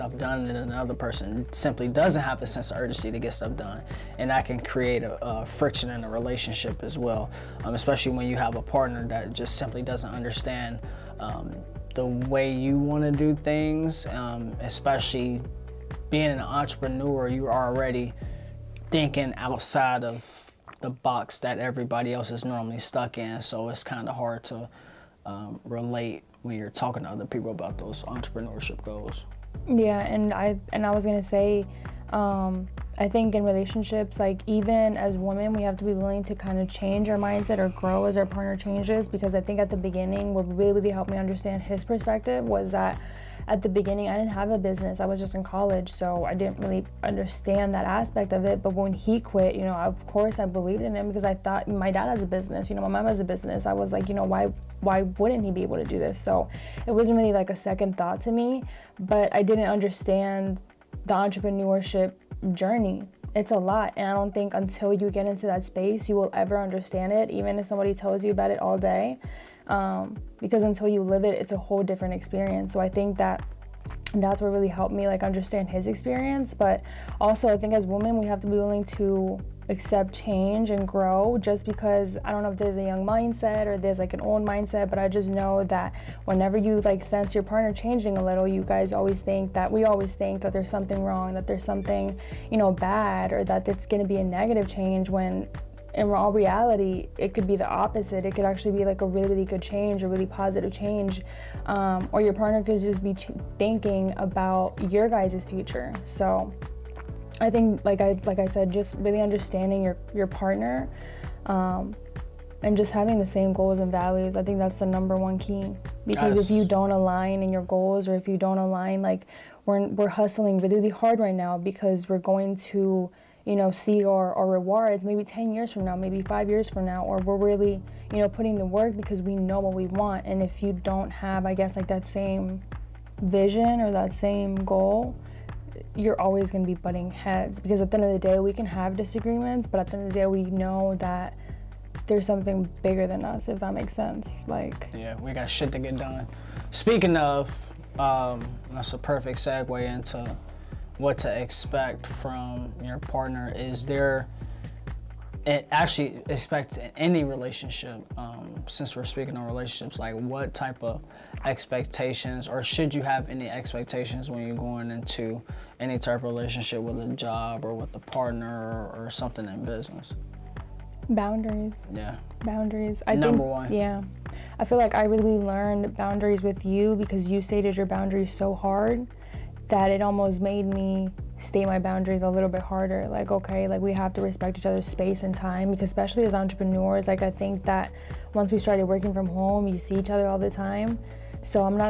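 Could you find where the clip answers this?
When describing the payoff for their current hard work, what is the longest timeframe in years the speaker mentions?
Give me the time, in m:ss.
2:05.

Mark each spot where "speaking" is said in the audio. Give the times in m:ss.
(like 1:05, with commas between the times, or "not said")
2:26, 2:39.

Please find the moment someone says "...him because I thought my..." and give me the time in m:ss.
0:50.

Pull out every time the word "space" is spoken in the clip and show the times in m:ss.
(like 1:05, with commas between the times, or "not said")
1:05, 3:04.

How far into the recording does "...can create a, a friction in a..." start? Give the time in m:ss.
0:04.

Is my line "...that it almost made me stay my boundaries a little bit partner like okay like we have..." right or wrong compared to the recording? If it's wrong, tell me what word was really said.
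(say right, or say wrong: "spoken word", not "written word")
wrong: "harder", not "partner".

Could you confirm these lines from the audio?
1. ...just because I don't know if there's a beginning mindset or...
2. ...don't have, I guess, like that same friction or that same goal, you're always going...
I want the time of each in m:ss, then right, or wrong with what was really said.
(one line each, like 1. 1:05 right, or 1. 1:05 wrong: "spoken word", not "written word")
1. 1:21 wrong: "young", not "beginning"
2. 2:10 wrong: "vision", not "friction".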